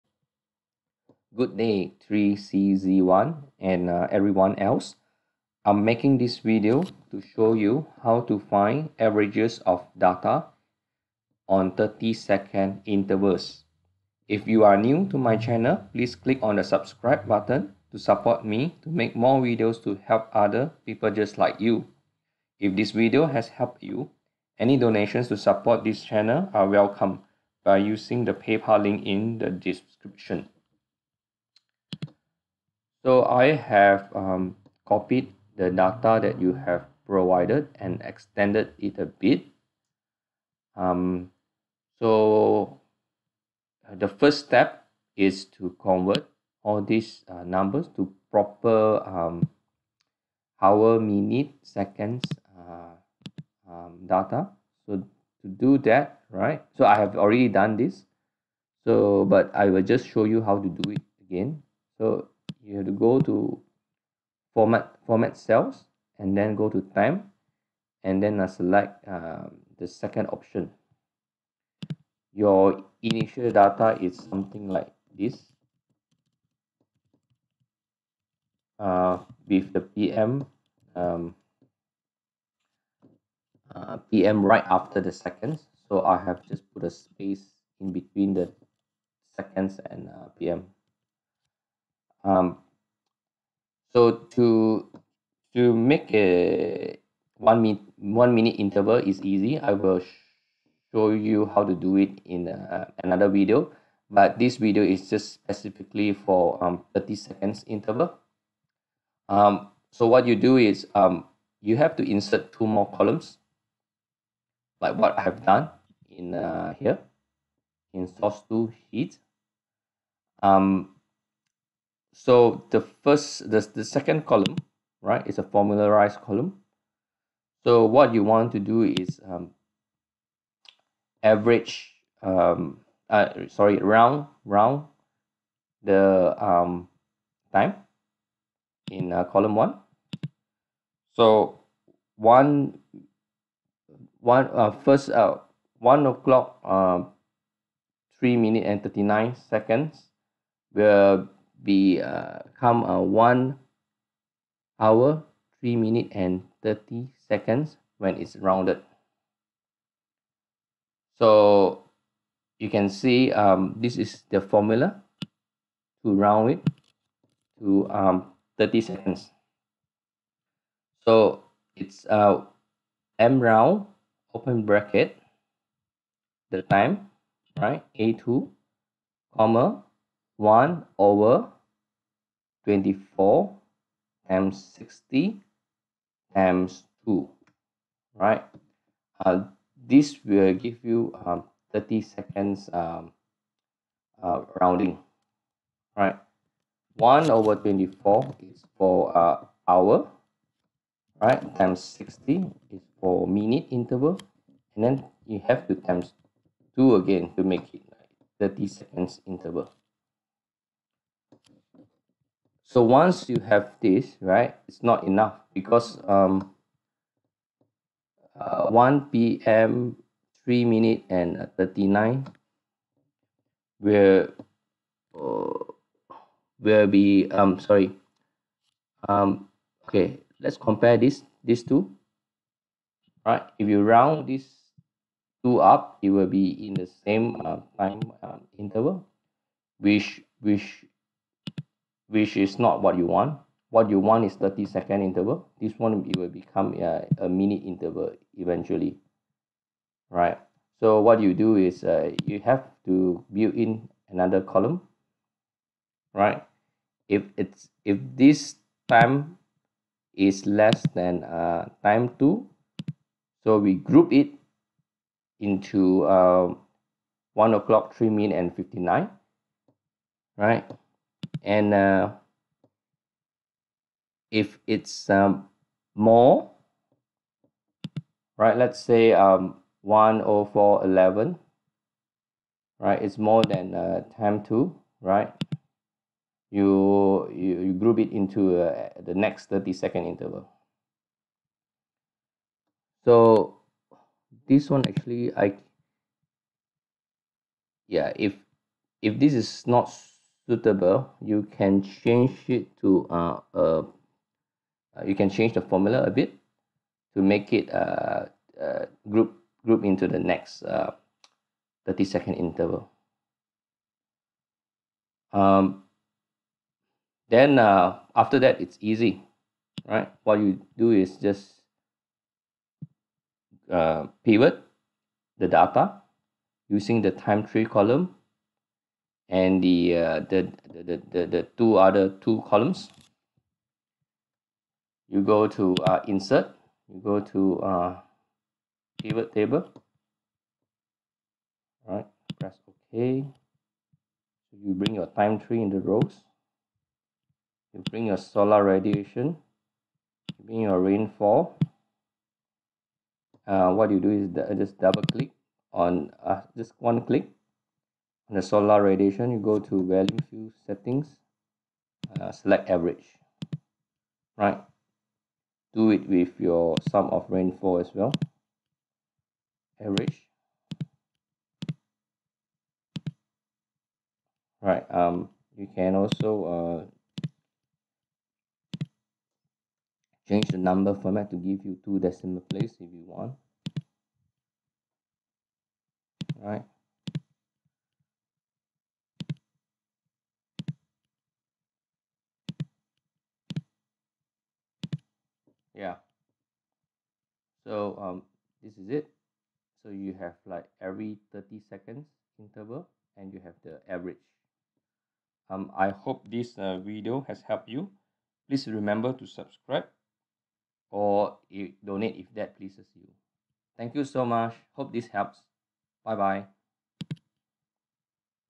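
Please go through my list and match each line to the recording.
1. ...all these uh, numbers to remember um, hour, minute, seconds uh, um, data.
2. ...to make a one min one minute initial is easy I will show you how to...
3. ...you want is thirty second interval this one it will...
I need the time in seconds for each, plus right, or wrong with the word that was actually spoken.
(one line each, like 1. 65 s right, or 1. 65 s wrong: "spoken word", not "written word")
1. 46 s wrong: "proper", not "remember"
2. 95 s wrong: "interval", not "initial"
3. 243 s right.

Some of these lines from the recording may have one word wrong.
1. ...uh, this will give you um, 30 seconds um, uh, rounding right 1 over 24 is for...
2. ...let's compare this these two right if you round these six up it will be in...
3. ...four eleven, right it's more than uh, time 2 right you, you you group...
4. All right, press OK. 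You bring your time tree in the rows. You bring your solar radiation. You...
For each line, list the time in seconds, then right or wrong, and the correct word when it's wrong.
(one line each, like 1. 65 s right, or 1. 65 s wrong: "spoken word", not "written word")
1. 189 s right
2. 230 s wrong: "two", not "six"
3. 280 s right
4. 341 s right.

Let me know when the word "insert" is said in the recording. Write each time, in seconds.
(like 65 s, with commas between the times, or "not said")
112 s, 336 s.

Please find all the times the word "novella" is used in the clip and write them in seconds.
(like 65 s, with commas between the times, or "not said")
not said.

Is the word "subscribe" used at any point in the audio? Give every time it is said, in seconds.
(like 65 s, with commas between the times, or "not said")
16 s, 409 s.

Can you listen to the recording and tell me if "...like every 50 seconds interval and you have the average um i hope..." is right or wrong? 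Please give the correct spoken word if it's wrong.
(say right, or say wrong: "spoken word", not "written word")
wrong: "30", not "50".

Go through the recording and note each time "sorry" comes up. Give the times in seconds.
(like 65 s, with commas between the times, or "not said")
133 s, 227 s.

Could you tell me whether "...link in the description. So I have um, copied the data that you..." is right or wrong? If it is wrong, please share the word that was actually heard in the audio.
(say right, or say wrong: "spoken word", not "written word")
right.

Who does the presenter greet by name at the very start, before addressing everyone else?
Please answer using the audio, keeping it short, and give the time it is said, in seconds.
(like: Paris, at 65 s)
3CZ1, at 2 s.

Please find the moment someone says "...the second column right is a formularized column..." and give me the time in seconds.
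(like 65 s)
123 s.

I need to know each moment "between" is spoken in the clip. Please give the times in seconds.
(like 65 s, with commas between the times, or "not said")
87 s.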